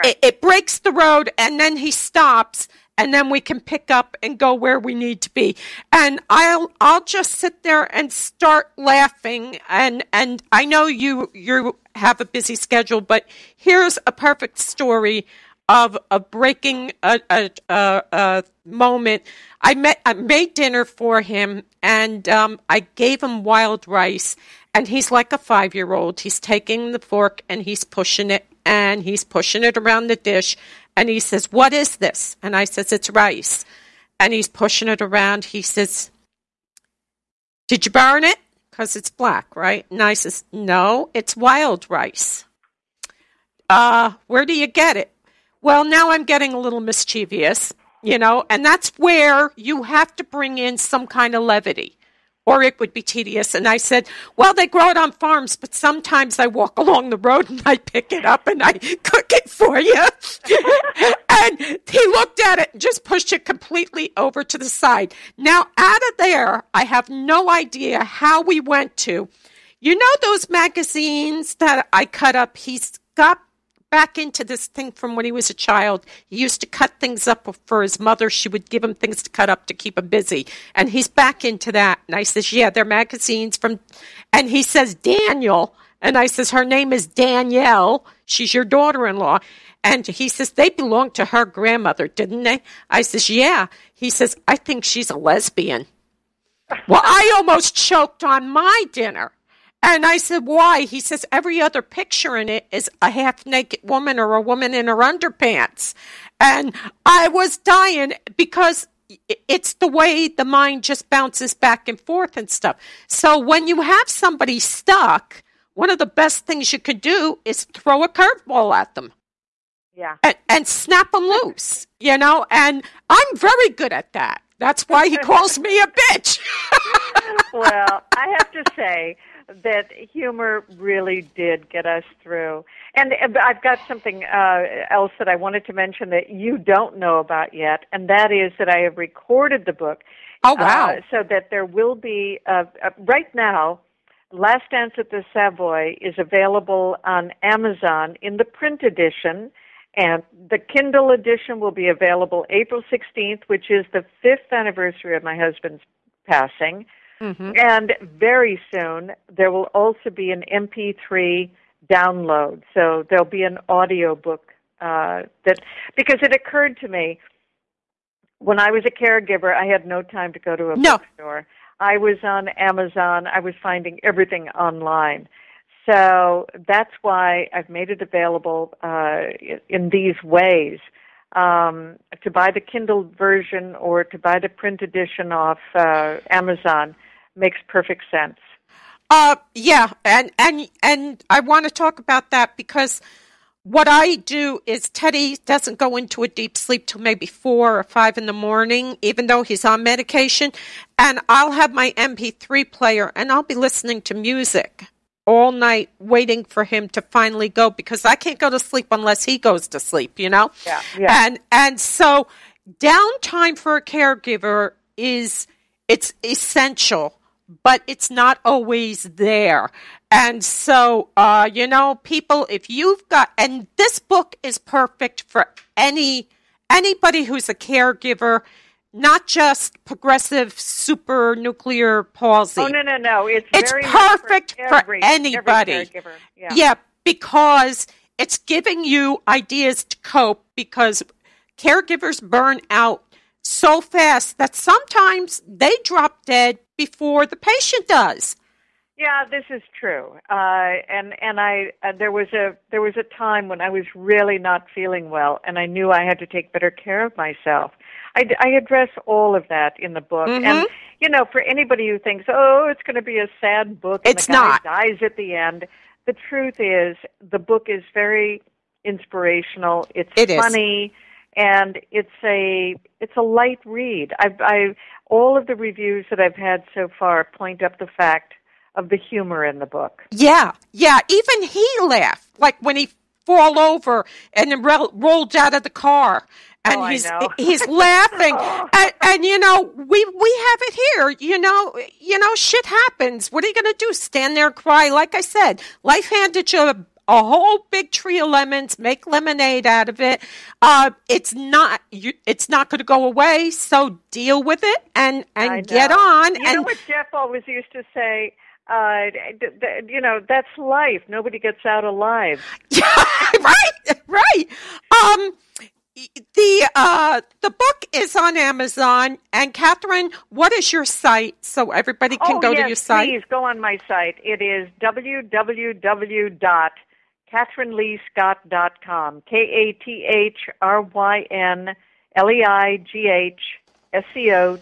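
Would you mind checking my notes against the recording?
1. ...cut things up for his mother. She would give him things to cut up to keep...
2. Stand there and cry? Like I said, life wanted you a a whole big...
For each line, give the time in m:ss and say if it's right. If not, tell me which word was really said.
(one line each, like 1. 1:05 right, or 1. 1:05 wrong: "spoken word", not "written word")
1. 1:16 right
2. 4:53 wrong: "handed", not "wanted".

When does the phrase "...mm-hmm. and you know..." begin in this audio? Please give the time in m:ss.
4:20.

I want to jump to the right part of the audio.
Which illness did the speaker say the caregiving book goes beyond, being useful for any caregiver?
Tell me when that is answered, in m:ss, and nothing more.
3:49.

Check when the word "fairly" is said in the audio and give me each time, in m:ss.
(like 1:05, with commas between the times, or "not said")
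not said.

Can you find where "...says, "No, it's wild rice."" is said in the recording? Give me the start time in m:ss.
0:40.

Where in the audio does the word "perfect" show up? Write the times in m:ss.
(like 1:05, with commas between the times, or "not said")
0:14, 3:07, 3:44, 3:53.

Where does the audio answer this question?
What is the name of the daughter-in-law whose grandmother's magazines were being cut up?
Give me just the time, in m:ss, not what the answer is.
1:27.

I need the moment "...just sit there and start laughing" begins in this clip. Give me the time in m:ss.
0:07.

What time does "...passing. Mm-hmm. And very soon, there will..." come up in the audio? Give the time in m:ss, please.
2:36.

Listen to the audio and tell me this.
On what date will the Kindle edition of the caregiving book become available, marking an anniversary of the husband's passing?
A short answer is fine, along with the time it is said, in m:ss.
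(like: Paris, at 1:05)
April 16th, at 2:32.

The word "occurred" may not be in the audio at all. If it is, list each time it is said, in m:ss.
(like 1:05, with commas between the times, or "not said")
2:46.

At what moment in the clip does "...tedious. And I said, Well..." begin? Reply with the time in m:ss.
0:53.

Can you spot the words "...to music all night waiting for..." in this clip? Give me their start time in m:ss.
3:24.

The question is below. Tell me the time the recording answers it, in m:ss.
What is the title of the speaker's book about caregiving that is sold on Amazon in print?
2:24.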